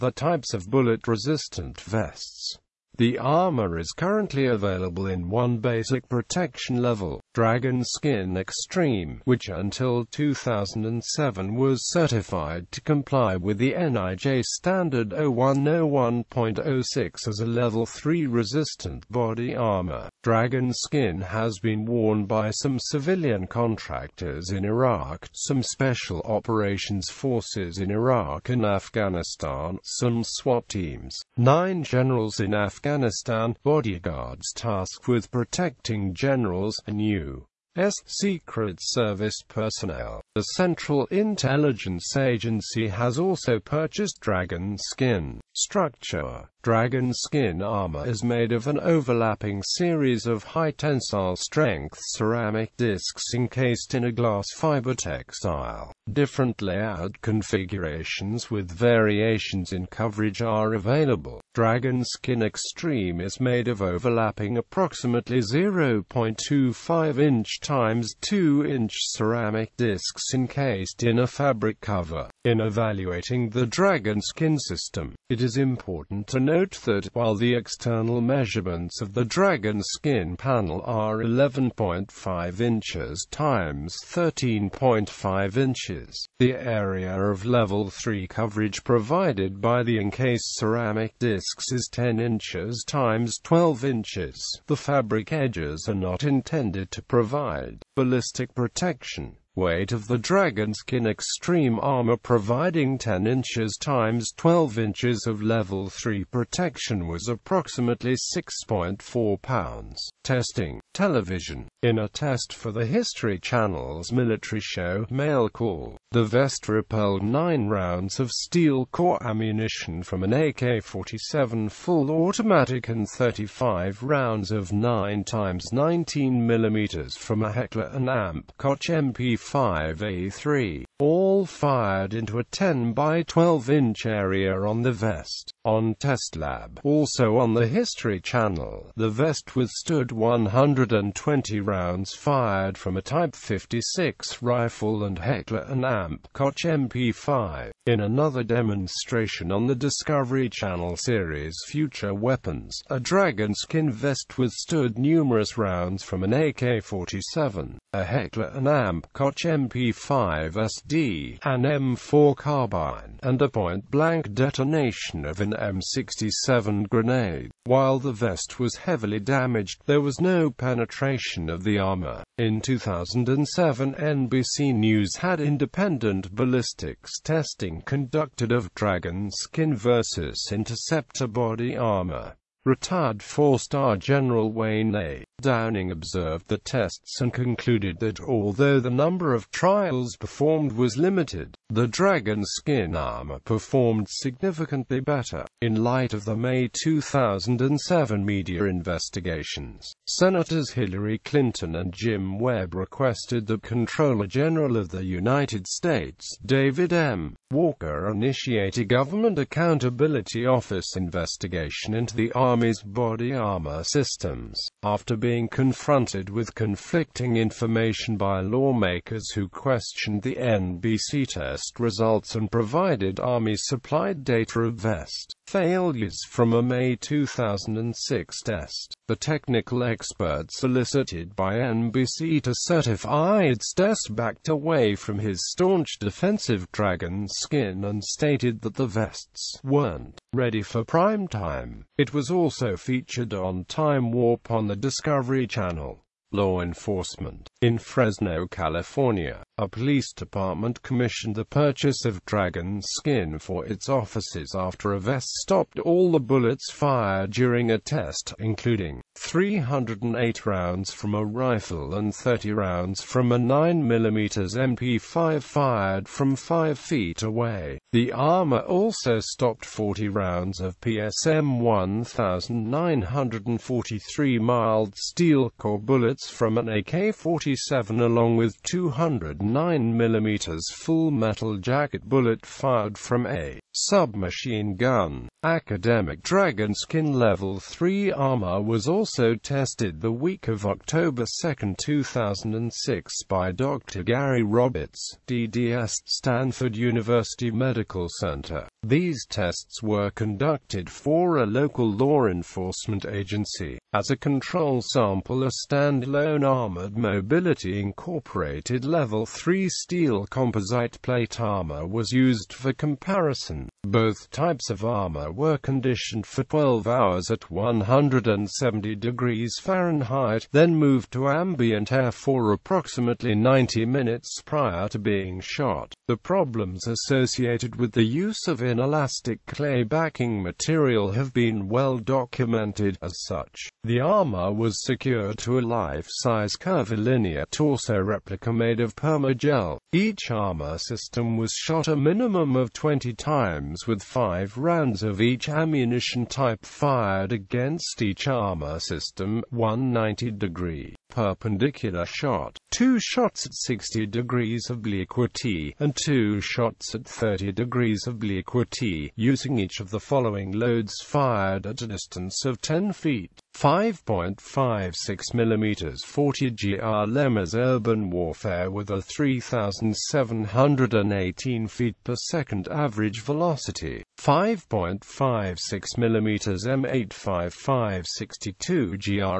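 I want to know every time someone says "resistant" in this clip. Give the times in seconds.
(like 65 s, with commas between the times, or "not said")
0 s, 18 s.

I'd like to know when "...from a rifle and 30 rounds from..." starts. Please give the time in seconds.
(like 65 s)
260 s.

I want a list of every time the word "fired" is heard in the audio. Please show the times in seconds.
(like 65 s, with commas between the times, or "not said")
131 s, 142 s, 256 s, 265 s, 282 s, 346 s, 361 s.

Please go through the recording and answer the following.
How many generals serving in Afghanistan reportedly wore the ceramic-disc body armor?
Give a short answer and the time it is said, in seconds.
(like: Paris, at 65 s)
9, at 31 s.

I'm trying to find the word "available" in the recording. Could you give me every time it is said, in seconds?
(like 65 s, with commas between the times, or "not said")
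4 s, 60 s.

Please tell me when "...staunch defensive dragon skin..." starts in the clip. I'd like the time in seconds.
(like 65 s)
235 s.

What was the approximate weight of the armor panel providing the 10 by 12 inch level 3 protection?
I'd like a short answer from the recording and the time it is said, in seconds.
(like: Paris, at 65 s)
6.4 pounds, at 108 s.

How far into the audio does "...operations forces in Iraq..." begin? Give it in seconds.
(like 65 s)
26 s.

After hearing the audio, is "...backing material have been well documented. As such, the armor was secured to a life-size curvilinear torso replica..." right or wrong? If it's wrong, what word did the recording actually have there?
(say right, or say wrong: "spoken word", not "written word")
right.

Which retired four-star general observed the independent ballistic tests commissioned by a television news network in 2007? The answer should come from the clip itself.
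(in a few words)
Wayne A. Downing.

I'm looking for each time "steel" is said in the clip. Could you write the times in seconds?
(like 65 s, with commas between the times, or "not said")
118 s, 274 s, 309 s.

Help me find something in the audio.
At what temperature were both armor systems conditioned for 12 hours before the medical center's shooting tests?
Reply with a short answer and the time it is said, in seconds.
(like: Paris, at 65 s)
170 degrees Fahrenheit, at 317 s.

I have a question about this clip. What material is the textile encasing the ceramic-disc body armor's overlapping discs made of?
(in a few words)
glass fiber.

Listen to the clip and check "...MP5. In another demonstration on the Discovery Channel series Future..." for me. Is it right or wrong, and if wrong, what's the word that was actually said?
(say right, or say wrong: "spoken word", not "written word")
right.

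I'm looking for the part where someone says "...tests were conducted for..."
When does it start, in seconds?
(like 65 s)
299 s.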